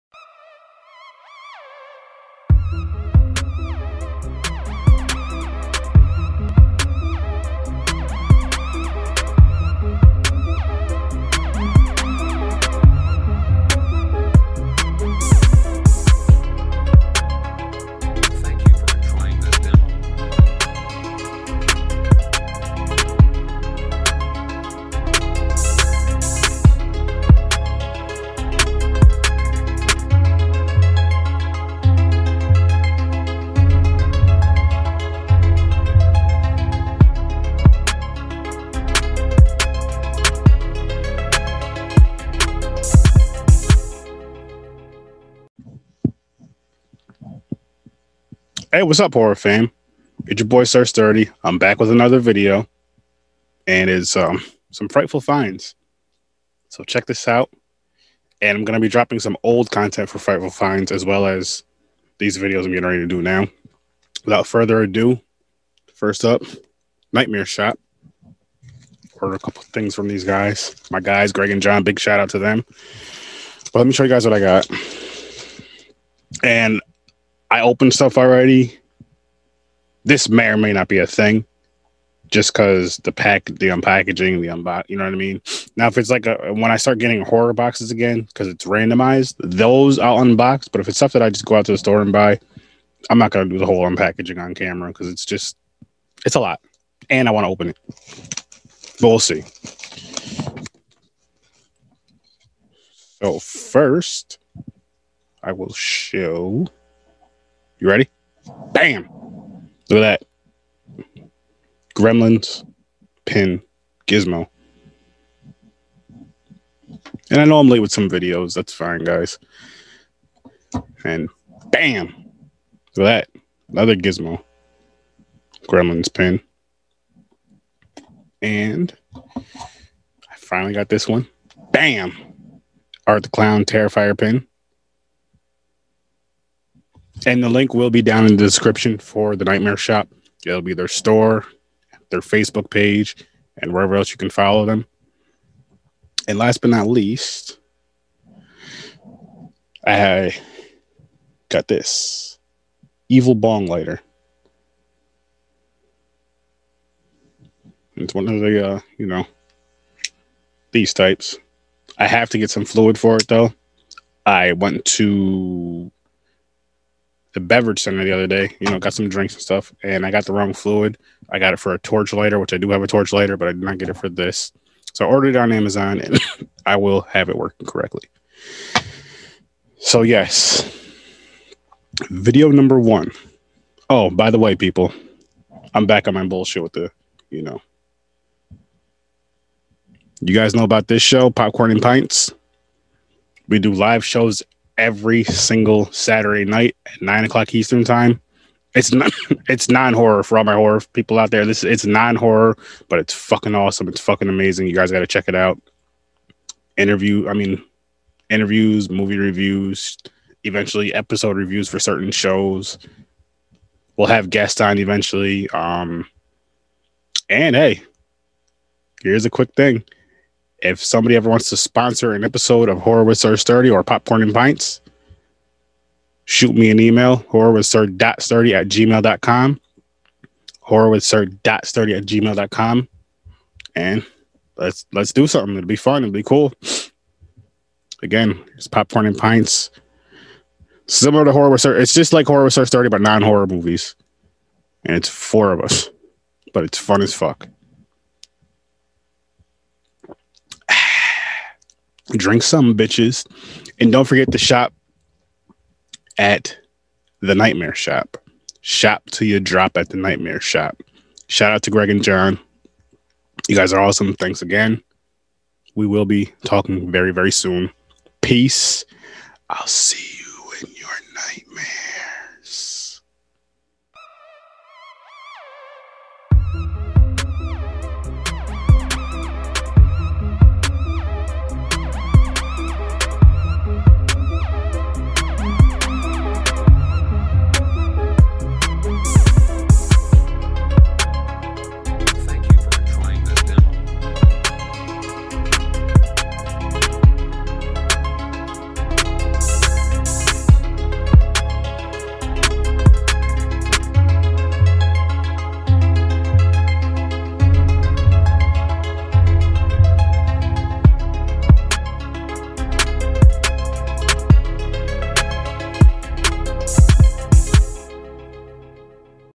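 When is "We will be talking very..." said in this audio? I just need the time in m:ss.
4:25.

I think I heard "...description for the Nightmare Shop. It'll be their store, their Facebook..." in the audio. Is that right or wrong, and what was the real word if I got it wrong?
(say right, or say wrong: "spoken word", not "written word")
right.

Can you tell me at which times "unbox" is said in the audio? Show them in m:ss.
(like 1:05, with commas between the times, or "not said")
1:24, 1:30.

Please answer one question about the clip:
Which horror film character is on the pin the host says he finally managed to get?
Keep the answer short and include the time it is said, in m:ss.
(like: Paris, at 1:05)
Art the Clown, at 2:13.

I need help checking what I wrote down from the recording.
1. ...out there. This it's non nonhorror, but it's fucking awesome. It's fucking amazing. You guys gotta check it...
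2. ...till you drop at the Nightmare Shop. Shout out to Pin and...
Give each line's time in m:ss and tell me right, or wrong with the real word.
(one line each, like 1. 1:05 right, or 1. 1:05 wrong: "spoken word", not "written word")
1. 3:21 wrong: "horror", not "nonhorror"
2. 4:19 wrong: "Greg", not "Pin".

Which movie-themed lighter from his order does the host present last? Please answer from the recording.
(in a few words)
Evil Bong.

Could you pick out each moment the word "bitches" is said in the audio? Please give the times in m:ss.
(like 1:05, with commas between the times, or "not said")
4:12.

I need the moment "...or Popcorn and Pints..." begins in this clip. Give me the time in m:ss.
3:43.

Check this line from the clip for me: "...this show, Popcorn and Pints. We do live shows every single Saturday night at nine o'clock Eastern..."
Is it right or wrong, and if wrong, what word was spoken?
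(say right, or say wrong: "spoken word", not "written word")
right.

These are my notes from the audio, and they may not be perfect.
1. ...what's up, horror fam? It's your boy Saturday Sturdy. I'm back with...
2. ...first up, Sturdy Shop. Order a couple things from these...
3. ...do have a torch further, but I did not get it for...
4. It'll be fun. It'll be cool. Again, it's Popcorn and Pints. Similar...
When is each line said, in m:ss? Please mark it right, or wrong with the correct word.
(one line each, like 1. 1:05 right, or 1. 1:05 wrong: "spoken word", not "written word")
1. 0:48 wrong: "Sir", not "Saturday"
2. 1:05 wrong: "Nightmare", not "Sturdy"
3. 2:52 wrong: "lighter", not "further"
4. 3:55 right.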